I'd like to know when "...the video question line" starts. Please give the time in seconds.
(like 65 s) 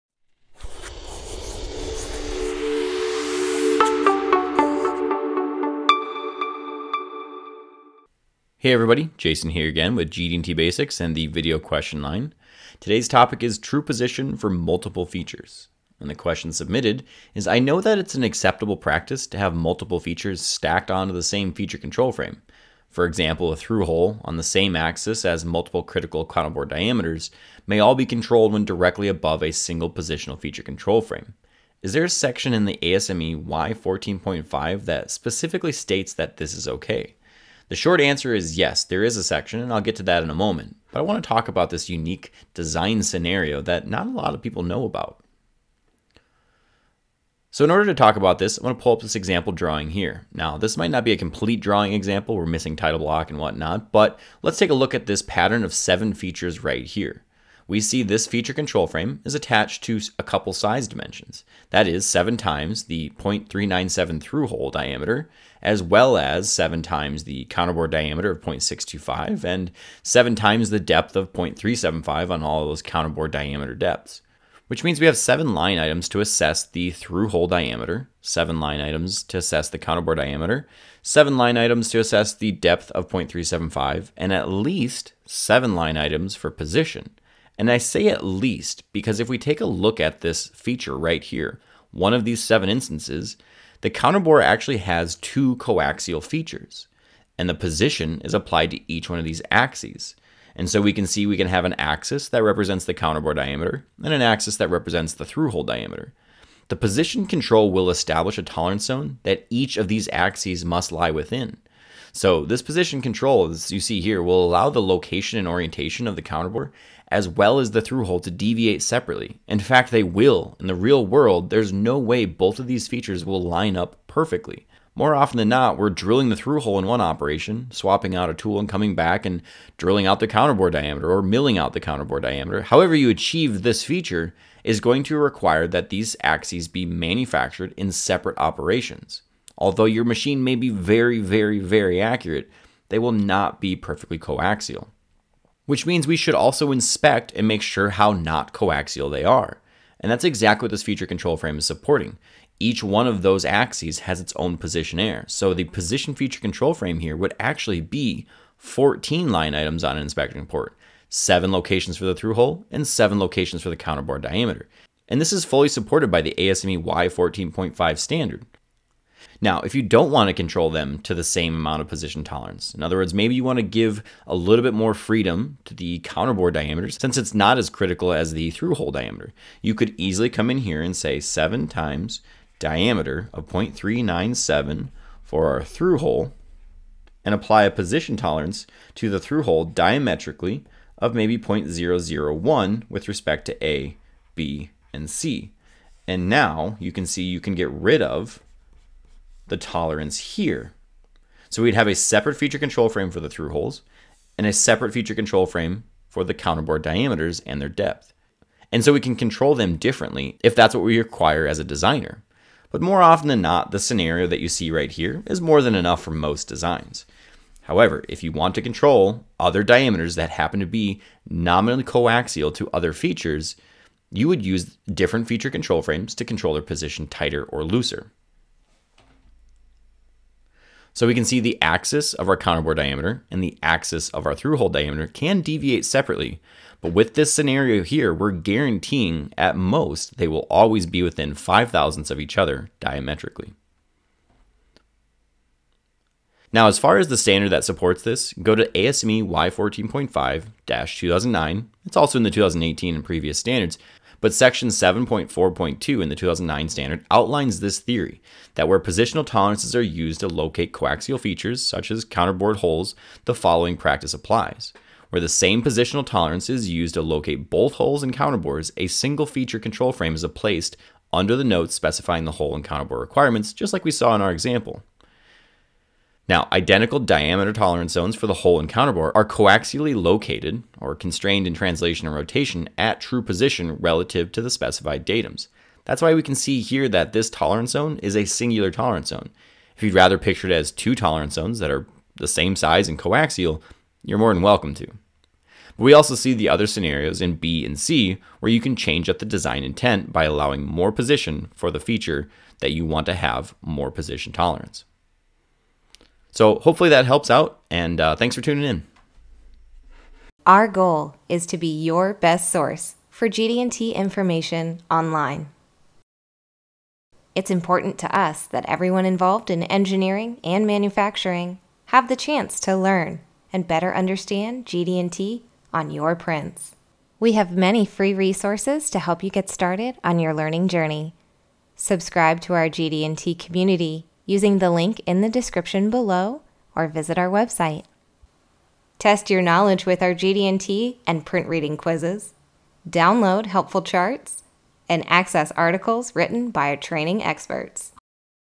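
11 s.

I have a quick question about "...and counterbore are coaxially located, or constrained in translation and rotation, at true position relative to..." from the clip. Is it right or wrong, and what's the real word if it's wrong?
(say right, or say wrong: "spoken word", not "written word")
right.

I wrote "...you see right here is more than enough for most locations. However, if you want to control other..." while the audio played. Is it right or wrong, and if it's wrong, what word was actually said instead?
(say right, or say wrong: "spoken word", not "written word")
wrong: "designs", not "locations".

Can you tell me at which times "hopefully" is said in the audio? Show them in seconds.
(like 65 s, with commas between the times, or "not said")
306 s.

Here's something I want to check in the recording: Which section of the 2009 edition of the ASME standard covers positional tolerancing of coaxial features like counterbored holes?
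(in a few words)
7.4.2.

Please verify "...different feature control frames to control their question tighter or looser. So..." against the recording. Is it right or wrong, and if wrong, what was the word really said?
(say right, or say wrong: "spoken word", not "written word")
wrong: "position", not "question".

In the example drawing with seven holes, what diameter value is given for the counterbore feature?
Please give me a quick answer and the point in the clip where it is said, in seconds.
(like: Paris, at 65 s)
0.625, at 68 s.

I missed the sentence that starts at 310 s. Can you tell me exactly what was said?
Our goal is to be your best source for GD&T information online.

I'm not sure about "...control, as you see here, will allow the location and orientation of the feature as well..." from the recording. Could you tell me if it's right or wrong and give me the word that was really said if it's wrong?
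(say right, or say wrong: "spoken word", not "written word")
wrong: "counterbore", not "feature".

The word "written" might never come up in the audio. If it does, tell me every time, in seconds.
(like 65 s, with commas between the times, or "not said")
346 s.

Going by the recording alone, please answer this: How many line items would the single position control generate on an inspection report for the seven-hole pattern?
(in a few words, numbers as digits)
14.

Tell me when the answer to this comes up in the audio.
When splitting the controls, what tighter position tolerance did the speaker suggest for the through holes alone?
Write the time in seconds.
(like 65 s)
191 s.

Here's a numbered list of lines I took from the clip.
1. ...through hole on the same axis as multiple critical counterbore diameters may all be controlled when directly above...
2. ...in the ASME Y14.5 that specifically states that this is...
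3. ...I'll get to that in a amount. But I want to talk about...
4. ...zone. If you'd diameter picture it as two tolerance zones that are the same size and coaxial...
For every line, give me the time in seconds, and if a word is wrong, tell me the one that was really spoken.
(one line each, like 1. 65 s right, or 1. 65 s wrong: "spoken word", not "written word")
1. 23 s right
2. 32 s right
3. 39 s wrong: "moment", not "amount"
4. 289 s wrong: "rather", not "diameter".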